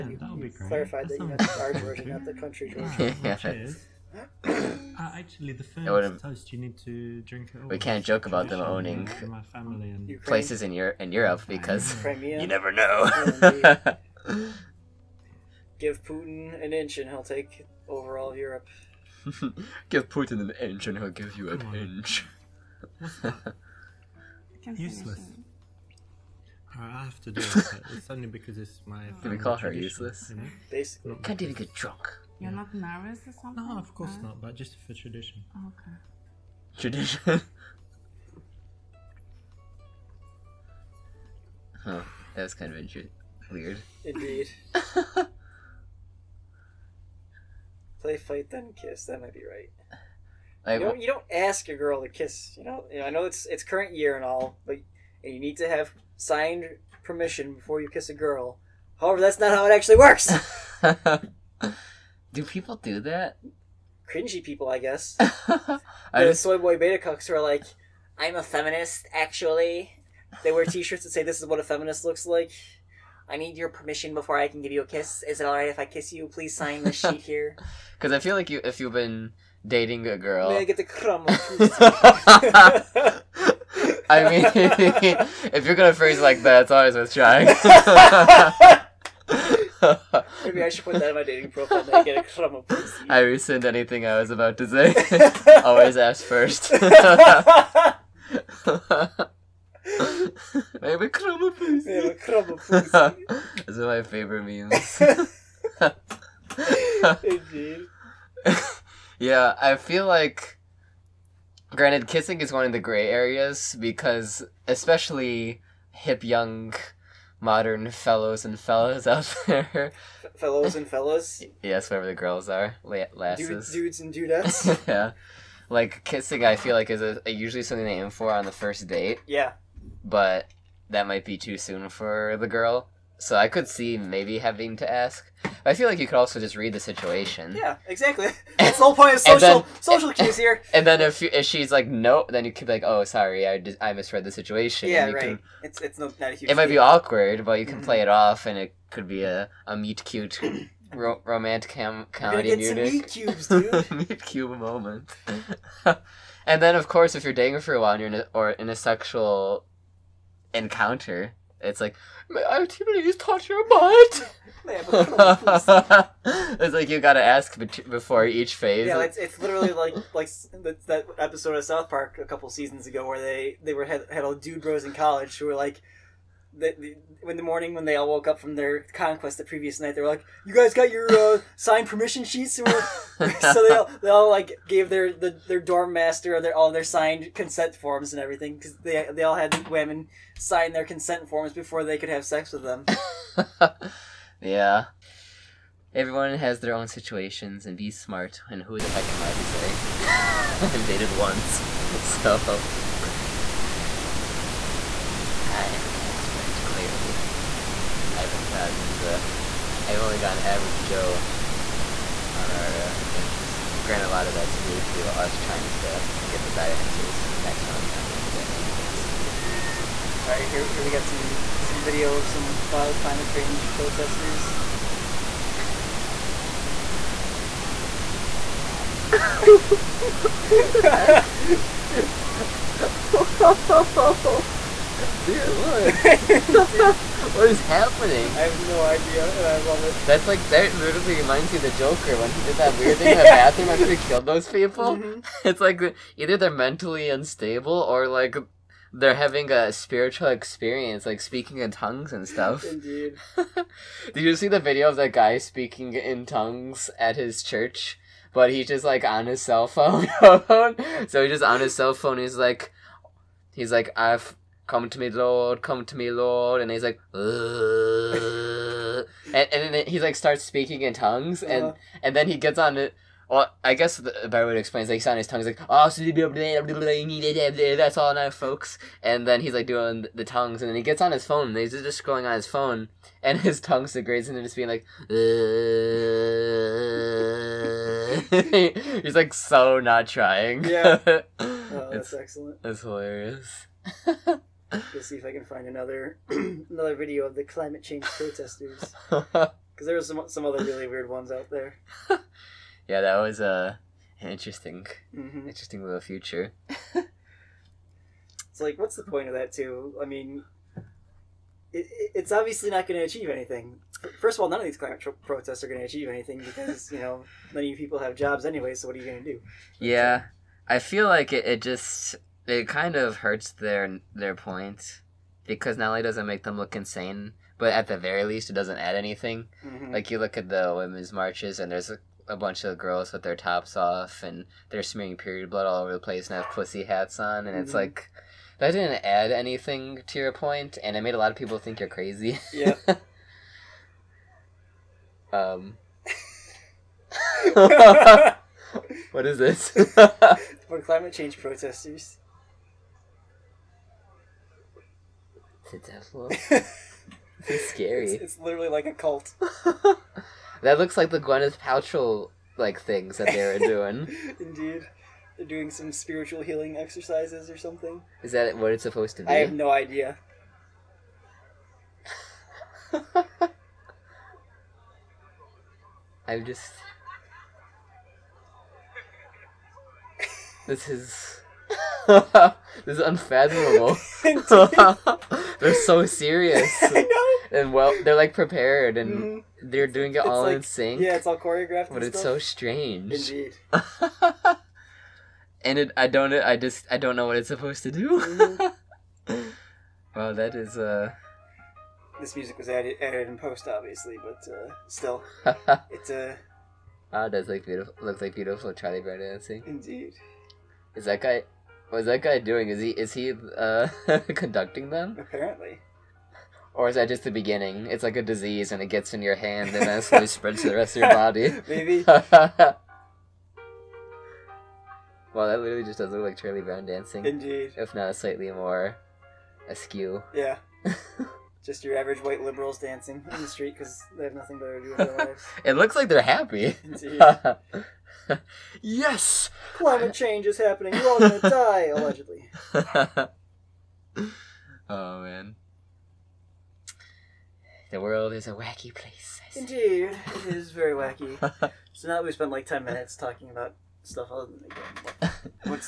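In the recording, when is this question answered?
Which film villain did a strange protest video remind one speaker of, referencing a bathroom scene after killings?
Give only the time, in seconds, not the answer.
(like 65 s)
241 s.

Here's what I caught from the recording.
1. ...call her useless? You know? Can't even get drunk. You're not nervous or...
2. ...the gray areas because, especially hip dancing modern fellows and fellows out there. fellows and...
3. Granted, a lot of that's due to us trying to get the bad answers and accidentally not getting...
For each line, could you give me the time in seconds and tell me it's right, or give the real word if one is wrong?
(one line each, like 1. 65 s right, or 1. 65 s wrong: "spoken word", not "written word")
1. 29 s right
2. 112 s wrong: "young", not "dancing"
3. 213 s right.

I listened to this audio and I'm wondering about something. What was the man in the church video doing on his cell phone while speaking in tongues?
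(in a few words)
scrolling.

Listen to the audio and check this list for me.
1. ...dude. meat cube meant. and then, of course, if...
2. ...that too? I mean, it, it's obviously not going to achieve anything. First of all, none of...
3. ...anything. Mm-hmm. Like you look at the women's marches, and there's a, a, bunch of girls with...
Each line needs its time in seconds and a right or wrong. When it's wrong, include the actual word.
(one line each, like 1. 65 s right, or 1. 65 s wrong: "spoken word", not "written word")
1. 153 s wrong: "moment", not "meant"
2. 309 s right
3. 328 s right.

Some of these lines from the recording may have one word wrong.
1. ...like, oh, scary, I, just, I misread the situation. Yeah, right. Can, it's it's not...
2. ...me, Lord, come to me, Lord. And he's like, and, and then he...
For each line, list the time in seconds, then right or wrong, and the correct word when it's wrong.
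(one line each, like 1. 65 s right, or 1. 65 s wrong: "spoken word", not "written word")
1. 142 s wrong: "sorry", not "scary"
2. 264 s right.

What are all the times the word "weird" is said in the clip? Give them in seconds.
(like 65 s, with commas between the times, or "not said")
43 s, 242 s, 300 s.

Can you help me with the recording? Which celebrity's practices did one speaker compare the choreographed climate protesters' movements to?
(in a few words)
Gwyneth Paltrow.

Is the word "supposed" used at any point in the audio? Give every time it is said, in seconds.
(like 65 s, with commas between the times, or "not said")
368 s, 397 s.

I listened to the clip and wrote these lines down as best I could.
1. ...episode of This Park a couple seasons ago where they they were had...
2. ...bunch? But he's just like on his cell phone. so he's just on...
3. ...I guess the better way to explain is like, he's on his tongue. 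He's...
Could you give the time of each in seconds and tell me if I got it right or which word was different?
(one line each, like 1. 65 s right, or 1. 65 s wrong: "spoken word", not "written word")
1. 171 s wrong: "South", not "This"
2. 257 s wrong: "church", not "bunch"
3. 273 s right.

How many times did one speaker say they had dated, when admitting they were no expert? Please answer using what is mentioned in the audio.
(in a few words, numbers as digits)
once.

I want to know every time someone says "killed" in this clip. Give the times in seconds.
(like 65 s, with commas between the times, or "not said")
243 s.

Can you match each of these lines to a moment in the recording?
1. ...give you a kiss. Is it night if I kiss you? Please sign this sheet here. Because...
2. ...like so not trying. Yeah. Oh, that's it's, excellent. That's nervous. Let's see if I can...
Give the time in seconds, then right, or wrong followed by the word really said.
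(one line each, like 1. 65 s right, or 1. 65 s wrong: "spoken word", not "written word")
1. 74 s wrong: "alright", not "night"
2. 289 s wrong: "hilarious", not "nervous".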